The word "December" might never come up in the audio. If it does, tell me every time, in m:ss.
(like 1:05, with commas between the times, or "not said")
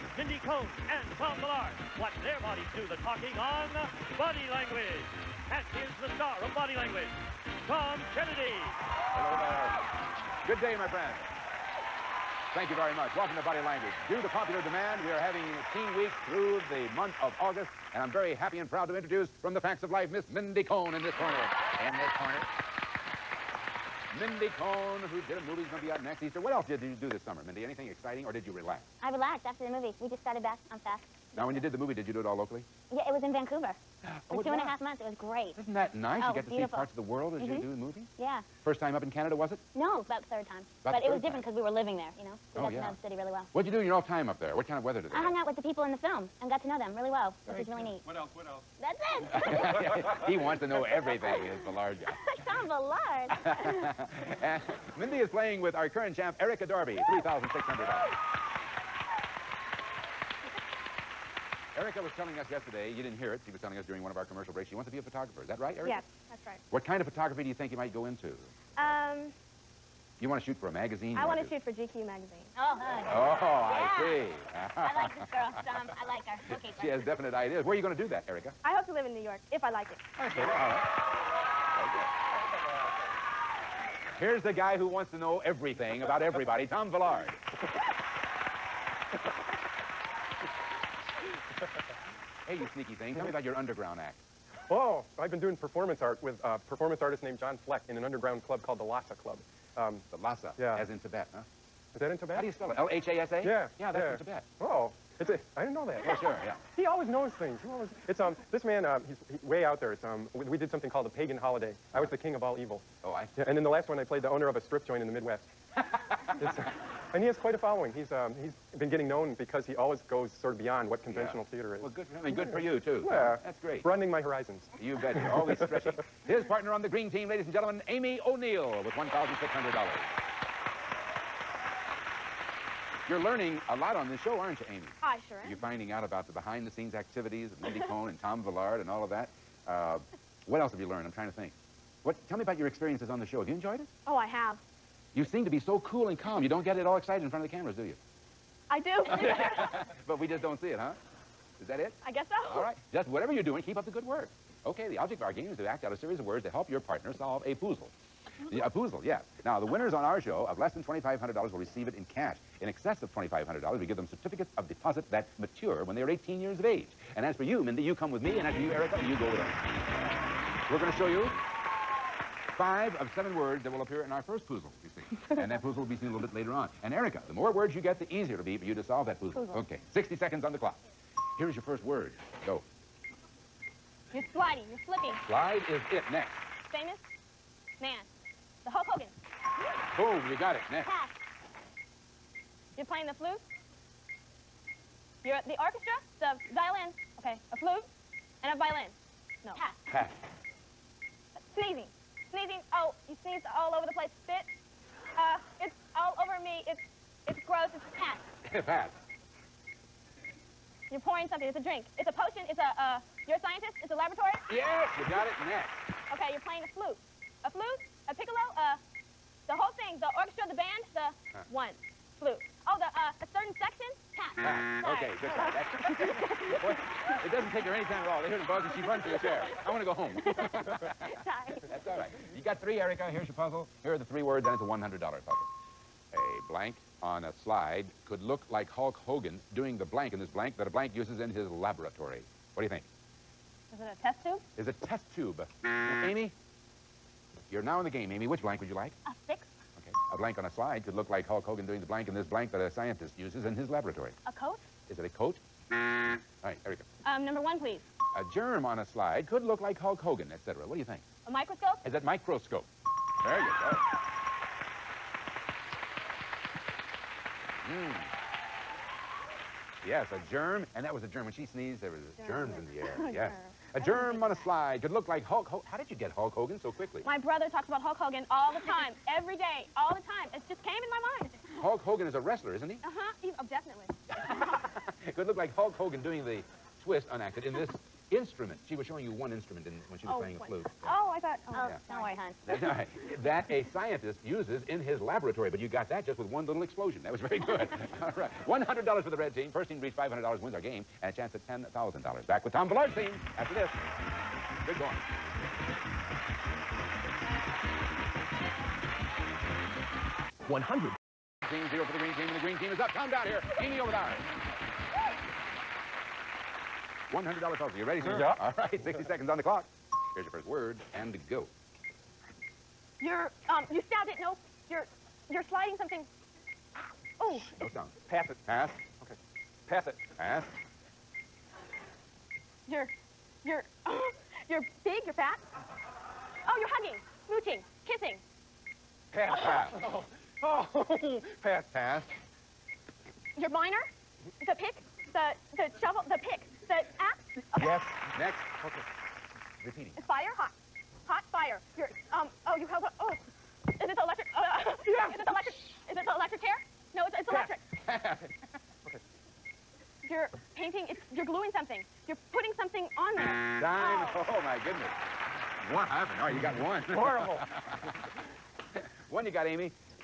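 not said.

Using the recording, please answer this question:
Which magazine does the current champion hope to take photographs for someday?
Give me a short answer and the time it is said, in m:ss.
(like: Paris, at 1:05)
GQ, at 1:11.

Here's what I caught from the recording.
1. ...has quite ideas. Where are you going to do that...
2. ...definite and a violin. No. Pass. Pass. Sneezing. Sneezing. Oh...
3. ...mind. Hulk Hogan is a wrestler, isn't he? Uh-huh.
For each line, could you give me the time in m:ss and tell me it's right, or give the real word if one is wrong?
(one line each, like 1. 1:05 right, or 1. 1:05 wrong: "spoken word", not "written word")
1. 1:16 wrong: "definite", not "quite"
2. 3:17 wrong: "flute", not "definite"
3. 4:41 right.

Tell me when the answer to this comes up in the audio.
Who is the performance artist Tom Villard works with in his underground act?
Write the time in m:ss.
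1:37.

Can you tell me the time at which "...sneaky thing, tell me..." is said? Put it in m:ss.
1:32.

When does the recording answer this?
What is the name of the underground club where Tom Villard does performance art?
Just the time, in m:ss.
1:38.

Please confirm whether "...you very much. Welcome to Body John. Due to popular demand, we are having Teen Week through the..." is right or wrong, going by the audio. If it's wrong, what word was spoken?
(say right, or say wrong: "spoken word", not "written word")
wrong: "Language", not "John".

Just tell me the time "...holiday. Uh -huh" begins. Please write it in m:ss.
1:51.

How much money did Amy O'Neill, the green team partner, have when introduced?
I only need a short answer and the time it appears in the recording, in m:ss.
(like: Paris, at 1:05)
$1,600, at 2:08.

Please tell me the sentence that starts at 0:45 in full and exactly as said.
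hung out with the people in the film and got to know them really well, Very which was really cool.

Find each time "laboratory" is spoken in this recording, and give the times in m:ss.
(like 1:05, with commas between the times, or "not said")
3:33, 4:01, 4:13, 4:54.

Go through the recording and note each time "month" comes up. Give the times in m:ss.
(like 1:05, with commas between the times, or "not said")
0:16, 0:34.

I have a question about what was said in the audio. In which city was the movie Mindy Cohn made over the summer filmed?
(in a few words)
Vancouver.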